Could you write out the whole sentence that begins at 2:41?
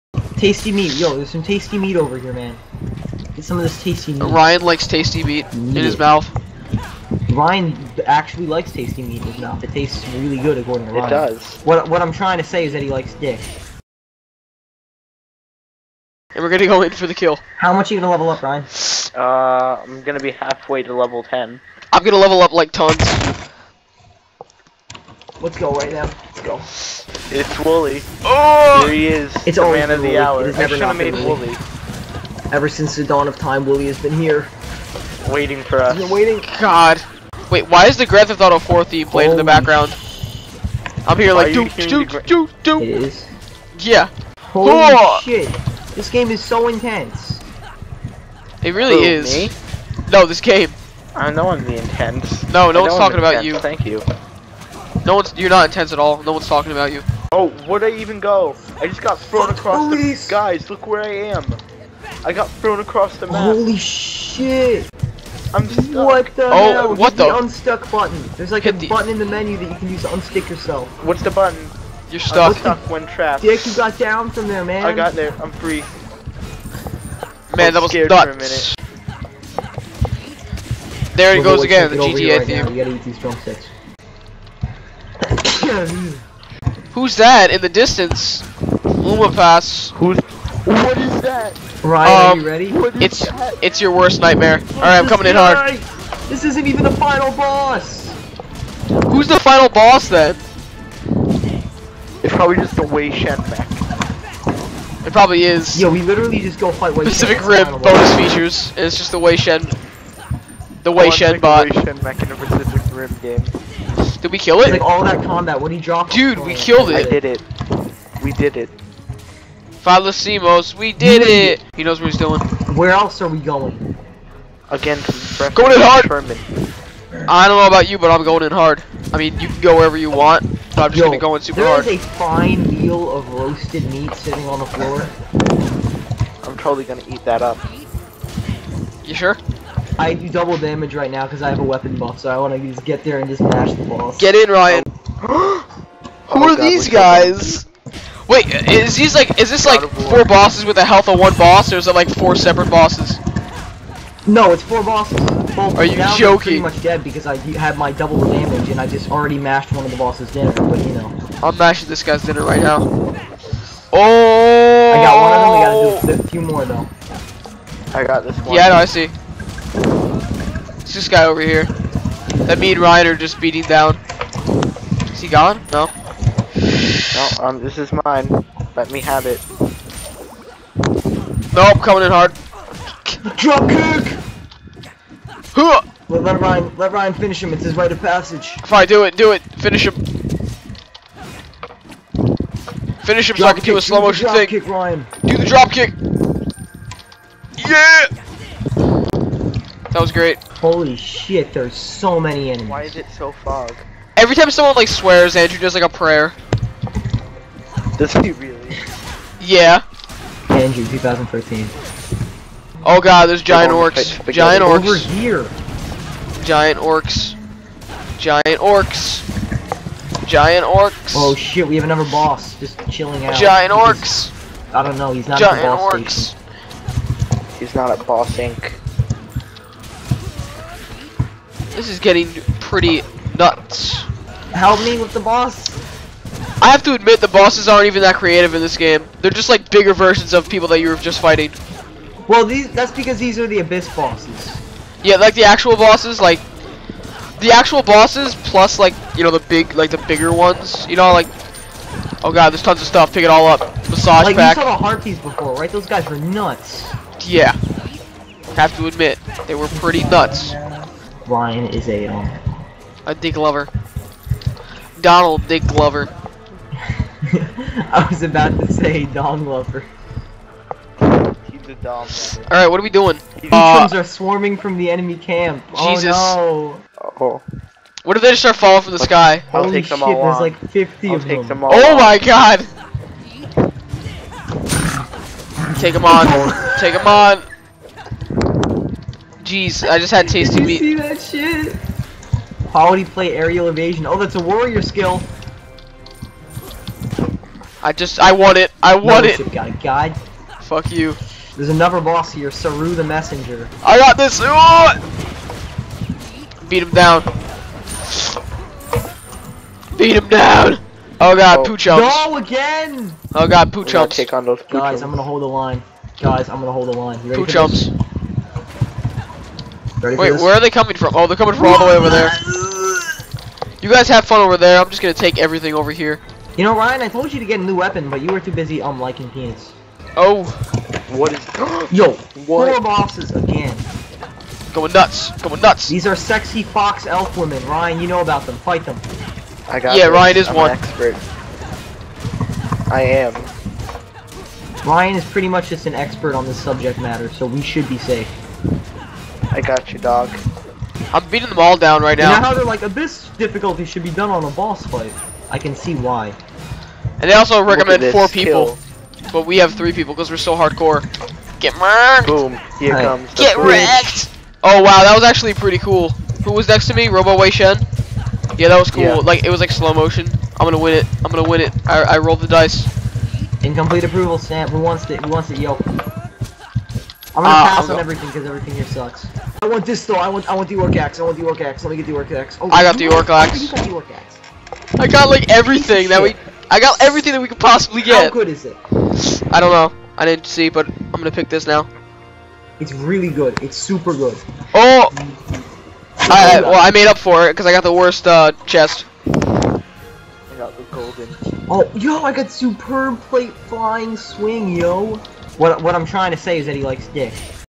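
I'm mashing this guy's dinner right now.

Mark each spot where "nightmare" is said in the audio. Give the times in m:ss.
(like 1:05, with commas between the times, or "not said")
1:34.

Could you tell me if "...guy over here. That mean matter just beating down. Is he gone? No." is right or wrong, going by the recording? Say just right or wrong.
wrong.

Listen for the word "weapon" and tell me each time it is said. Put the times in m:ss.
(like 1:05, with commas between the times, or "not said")
2:21, 5:27.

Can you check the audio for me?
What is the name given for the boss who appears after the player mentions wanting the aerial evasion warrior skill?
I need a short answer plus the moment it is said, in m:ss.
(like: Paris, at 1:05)
Saru the Messenger, at 5:02.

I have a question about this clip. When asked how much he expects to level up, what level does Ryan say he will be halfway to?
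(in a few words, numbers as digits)
10.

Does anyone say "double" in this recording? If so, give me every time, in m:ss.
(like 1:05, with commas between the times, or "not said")
2:20, 2:37.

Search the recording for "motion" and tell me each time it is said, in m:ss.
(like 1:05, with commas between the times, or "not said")
3:14, 6:09.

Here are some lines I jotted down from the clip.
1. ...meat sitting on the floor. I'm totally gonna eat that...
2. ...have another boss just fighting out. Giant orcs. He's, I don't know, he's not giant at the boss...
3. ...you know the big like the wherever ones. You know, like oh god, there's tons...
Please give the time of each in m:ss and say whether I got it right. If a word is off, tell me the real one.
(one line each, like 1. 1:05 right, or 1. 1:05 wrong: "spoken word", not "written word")
1. 2:13 right
2. 3:41 wrong: "chilling", not "fighting"
3. 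4:09 wrong: "bigger", not "wherever".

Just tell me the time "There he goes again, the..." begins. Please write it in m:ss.
1:21.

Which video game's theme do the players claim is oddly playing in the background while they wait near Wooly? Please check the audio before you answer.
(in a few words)
Grand Theft Auto 4.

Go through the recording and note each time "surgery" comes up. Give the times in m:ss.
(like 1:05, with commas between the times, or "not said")
not said.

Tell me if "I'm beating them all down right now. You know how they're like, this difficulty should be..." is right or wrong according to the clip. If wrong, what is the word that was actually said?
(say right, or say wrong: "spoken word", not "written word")
right.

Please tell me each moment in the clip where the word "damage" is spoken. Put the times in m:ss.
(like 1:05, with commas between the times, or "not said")
2:20, 2:38.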